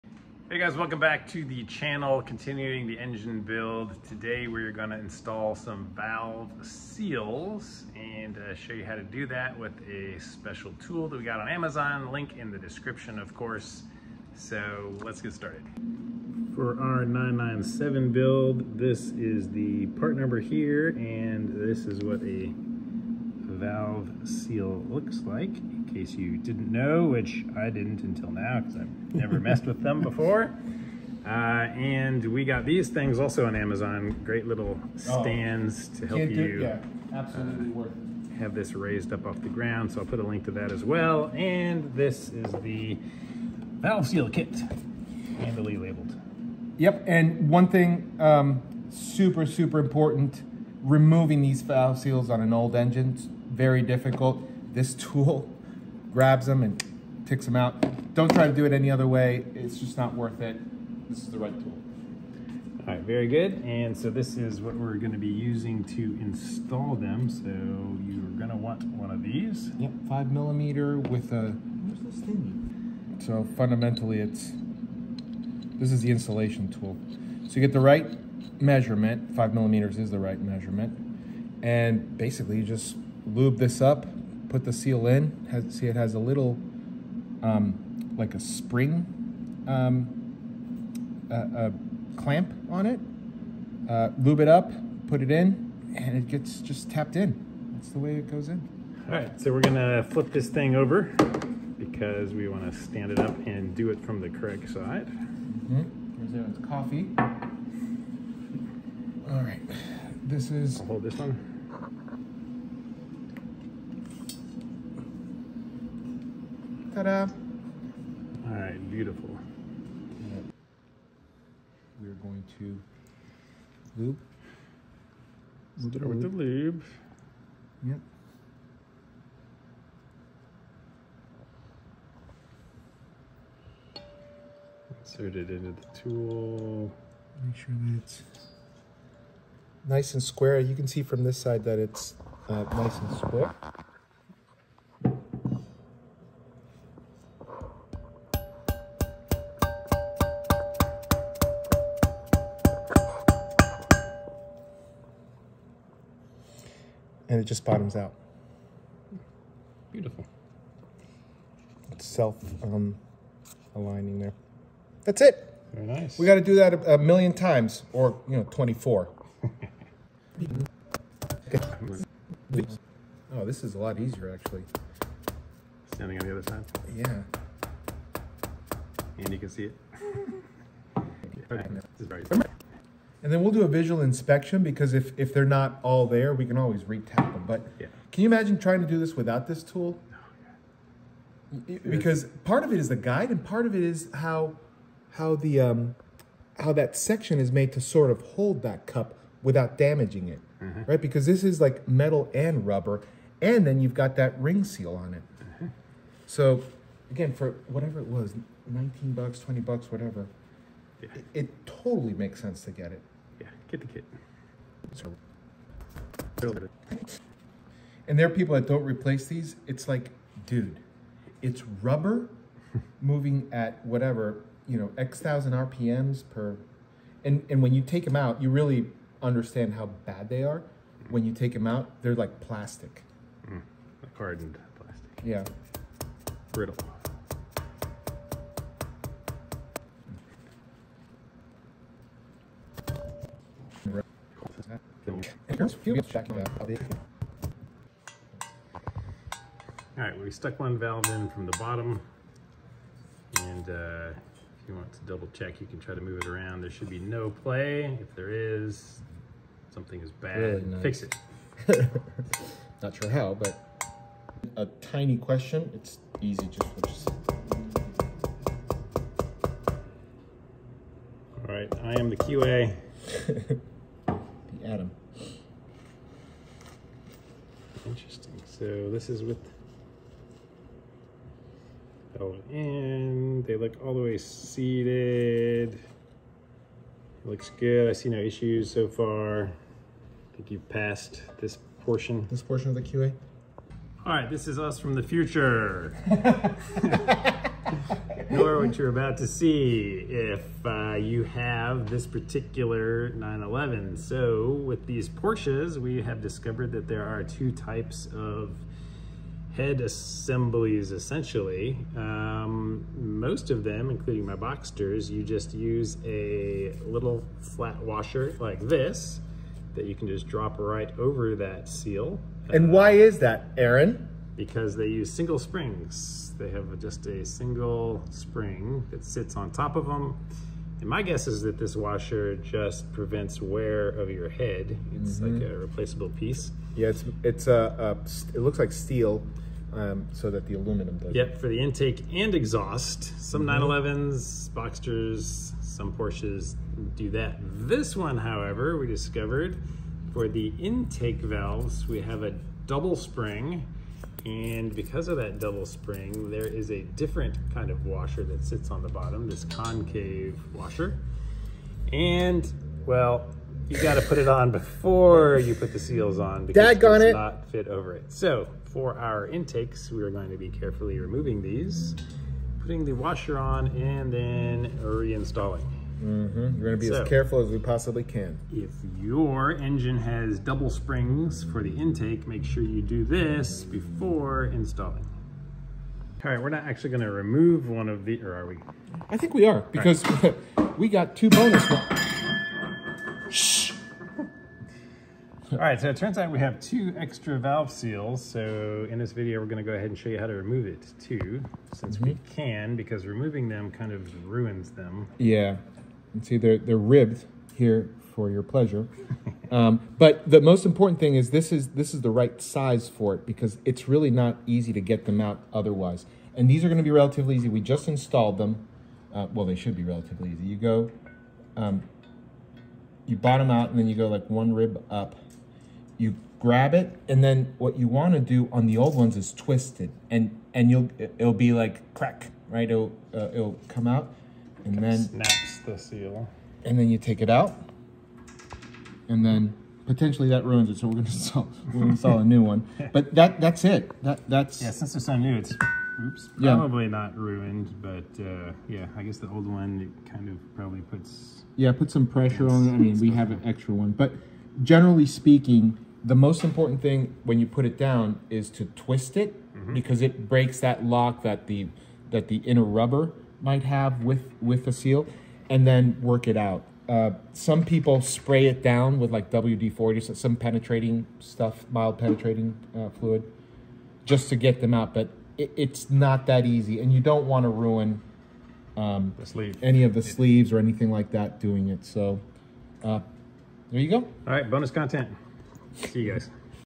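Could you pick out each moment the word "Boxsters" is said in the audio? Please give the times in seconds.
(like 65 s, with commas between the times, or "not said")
314 s, 344 s.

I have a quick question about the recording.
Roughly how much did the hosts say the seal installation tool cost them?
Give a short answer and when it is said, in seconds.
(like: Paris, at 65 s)
19 or 20 dollars, at 208 s.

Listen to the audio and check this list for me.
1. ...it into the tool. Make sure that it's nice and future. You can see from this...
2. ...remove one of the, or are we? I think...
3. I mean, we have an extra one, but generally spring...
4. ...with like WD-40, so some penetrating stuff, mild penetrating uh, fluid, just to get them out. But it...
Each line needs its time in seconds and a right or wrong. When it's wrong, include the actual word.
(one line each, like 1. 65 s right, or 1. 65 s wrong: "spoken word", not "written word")
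1. 135 s wrong: "square", not "future"
2. 387 s right
3. 452 s wrong: "speaking", not "spring"
4. 468 s right.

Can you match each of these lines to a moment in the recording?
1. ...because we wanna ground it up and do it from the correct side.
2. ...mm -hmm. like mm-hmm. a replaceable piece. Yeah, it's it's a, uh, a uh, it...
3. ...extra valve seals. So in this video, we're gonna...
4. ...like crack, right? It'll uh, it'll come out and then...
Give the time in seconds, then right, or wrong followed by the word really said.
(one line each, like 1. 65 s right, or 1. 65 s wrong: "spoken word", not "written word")
1. 101 s wrong: "stand", not "ground"
2. 334 s right
3. 396 s right
4. 431 s right.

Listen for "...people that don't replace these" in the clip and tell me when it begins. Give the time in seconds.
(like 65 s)
218 s.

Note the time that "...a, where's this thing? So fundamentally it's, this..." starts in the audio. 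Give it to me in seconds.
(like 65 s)
71 s.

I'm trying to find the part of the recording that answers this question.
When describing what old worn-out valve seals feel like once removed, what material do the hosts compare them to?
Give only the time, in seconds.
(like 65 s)
234 s.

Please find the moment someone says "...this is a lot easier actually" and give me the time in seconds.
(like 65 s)
173 s.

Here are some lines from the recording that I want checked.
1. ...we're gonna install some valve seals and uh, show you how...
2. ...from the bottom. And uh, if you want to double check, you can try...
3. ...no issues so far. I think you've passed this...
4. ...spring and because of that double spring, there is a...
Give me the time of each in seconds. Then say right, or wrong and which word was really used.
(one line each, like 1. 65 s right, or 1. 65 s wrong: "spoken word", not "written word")
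1. 4 s right
2. 251 s right
3. 288 s right
4. 353 s right.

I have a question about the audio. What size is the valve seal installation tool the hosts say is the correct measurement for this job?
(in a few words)
5 millimeters.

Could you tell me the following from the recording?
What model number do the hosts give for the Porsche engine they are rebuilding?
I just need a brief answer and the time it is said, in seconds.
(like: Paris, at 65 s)
997, at 17 s.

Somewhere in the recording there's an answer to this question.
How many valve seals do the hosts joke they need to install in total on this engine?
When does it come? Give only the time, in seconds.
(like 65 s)
168 s.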